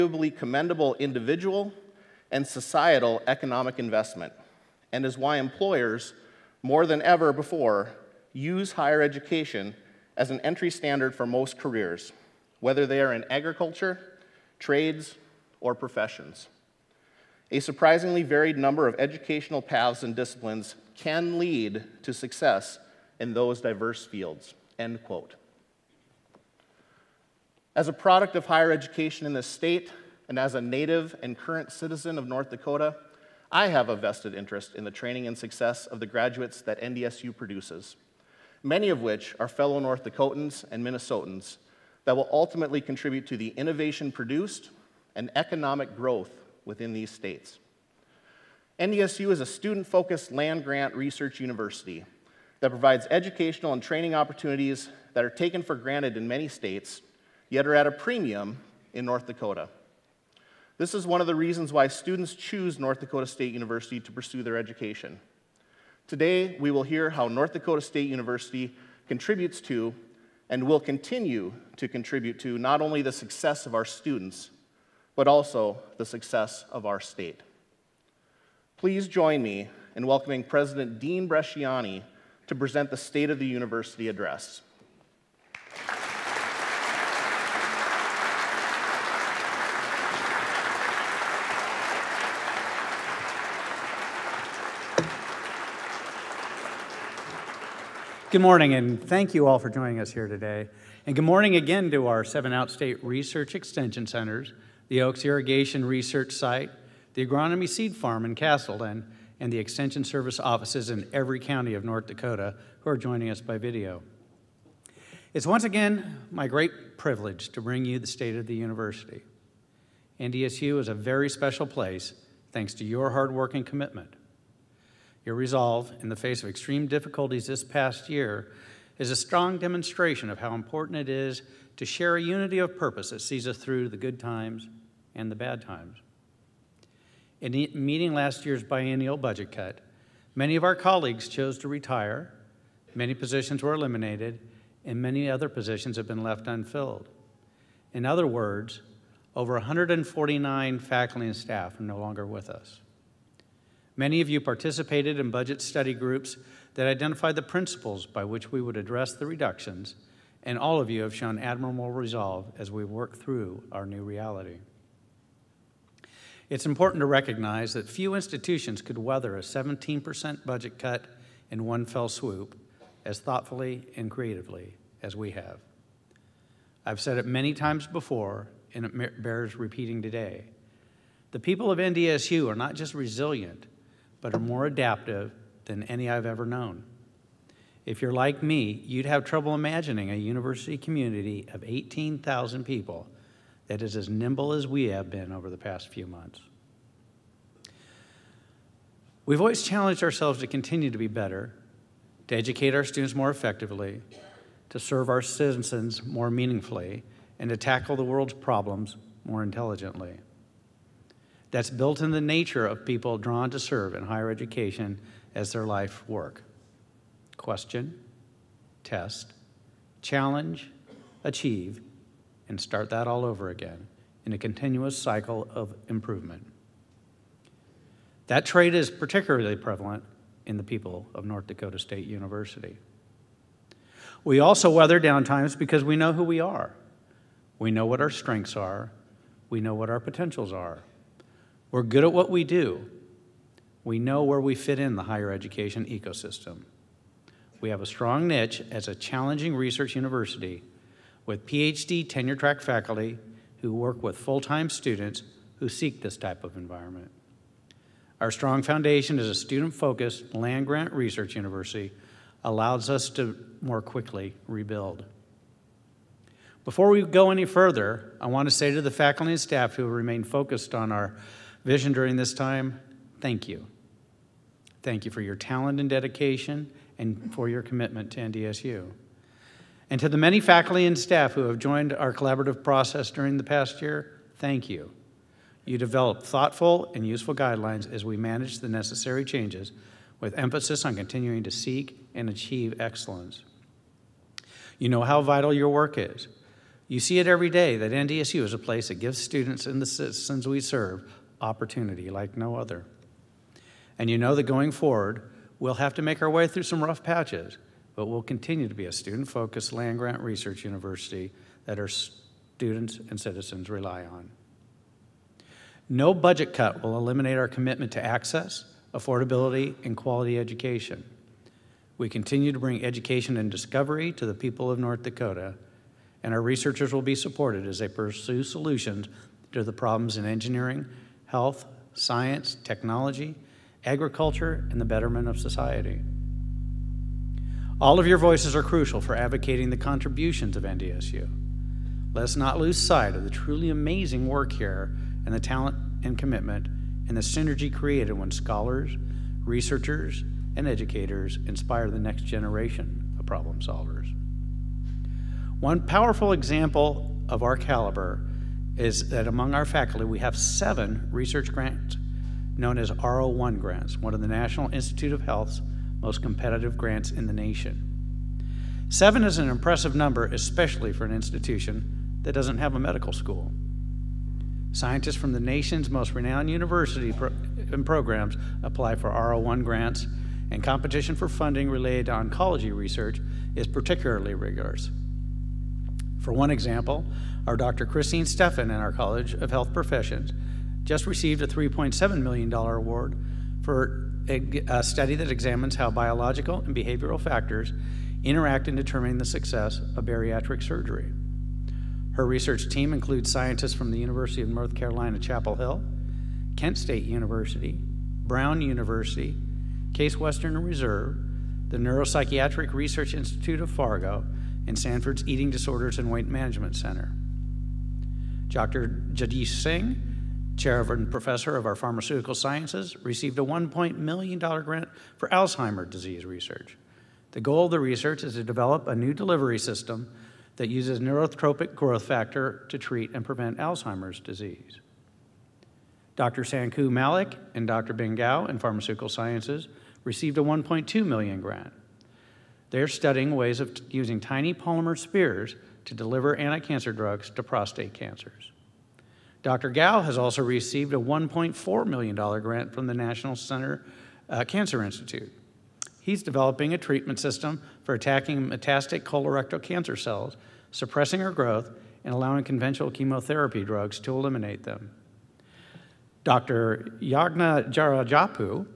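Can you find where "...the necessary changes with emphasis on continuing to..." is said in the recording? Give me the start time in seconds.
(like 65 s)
288 s.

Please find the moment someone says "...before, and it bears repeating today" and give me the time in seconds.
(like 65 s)
177 s.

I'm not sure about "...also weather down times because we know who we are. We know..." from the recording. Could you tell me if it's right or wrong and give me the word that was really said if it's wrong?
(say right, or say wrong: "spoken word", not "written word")
right.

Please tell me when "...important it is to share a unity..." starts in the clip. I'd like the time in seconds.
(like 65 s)
130 s.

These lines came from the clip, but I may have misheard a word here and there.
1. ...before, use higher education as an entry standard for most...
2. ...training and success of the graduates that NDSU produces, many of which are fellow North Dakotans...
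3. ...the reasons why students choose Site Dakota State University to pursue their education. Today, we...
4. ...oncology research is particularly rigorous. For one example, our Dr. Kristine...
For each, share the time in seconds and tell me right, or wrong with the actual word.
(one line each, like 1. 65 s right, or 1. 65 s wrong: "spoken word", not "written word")
1. 7 s right
2. 34 s right
3. 61 s wrong: "North", not "Site"
4. 382 s right.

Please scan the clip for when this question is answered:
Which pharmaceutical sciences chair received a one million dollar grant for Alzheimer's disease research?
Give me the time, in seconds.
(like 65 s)
419 s.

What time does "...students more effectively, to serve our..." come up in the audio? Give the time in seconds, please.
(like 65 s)
202 s.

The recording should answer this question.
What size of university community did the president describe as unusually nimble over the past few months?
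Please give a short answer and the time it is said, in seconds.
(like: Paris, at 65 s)
18,000 people, at 191 s.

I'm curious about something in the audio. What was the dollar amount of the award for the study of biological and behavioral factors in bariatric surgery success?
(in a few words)
$3.7 million.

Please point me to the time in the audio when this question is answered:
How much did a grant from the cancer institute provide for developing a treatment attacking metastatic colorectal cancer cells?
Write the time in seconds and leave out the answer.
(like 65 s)
450 s.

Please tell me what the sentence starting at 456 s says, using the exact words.
He's developing a treatment system for attacking metastatic colorectal cancer cells, suppressing their growth, and allowing conventional chemotherapy drugs to eliminate them.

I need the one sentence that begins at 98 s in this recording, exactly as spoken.
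Good morning, and thank you all for joining us here today.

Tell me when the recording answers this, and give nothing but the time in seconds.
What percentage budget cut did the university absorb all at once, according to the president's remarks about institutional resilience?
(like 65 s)
169 s.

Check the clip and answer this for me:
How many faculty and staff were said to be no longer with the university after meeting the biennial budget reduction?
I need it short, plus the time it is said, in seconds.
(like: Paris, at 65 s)
over 149, at 149 s.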